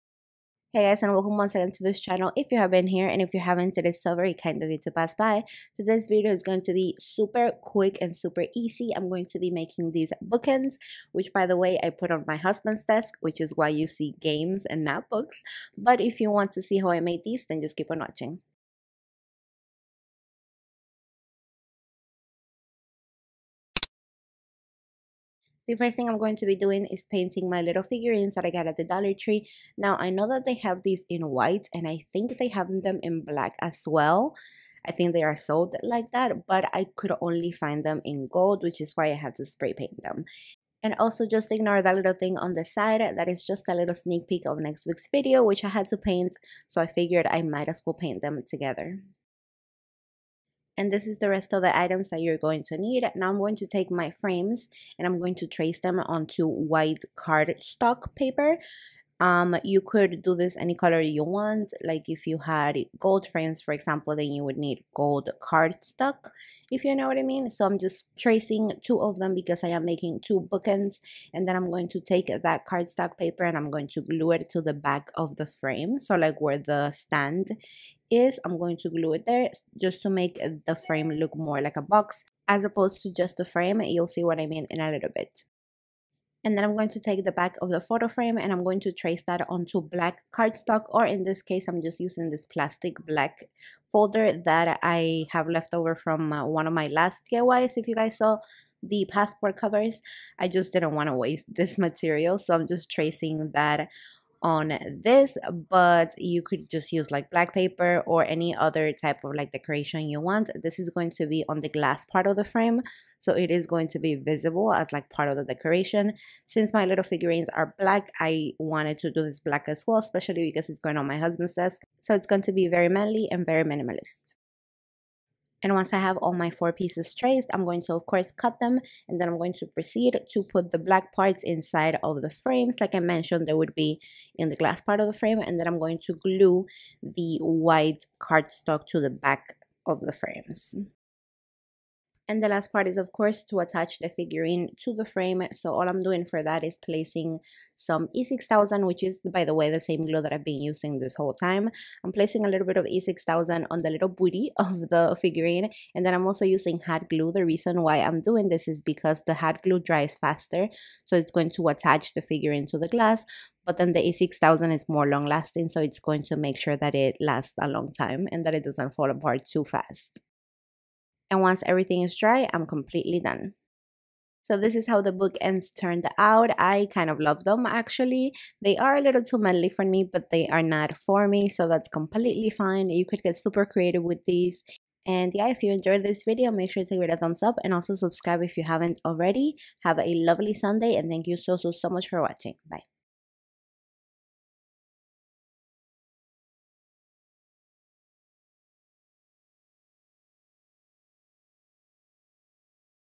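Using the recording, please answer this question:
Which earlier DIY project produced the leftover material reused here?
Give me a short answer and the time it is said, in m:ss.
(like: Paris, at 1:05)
Passport covers, at 1:39.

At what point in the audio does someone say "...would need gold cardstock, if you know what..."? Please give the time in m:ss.
1:04.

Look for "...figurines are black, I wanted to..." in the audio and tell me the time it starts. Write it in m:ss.
1:57.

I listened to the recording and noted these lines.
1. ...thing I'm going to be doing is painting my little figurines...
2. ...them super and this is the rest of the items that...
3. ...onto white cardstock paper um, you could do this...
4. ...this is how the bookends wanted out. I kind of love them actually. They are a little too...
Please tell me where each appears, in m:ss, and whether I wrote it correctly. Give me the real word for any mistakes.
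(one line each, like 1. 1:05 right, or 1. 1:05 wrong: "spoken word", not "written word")
1. 0:25 right
2. 0:48 wrong: "together", not "super"
3. 0:55 right
4. 2:54 wrong: "turned", not "wanted".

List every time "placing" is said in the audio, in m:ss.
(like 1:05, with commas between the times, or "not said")
2:26, 2:32.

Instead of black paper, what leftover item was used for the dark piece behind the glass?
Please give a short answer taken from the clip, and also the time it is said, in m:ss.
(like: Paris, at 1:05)
Plastic black folder, at 1:32.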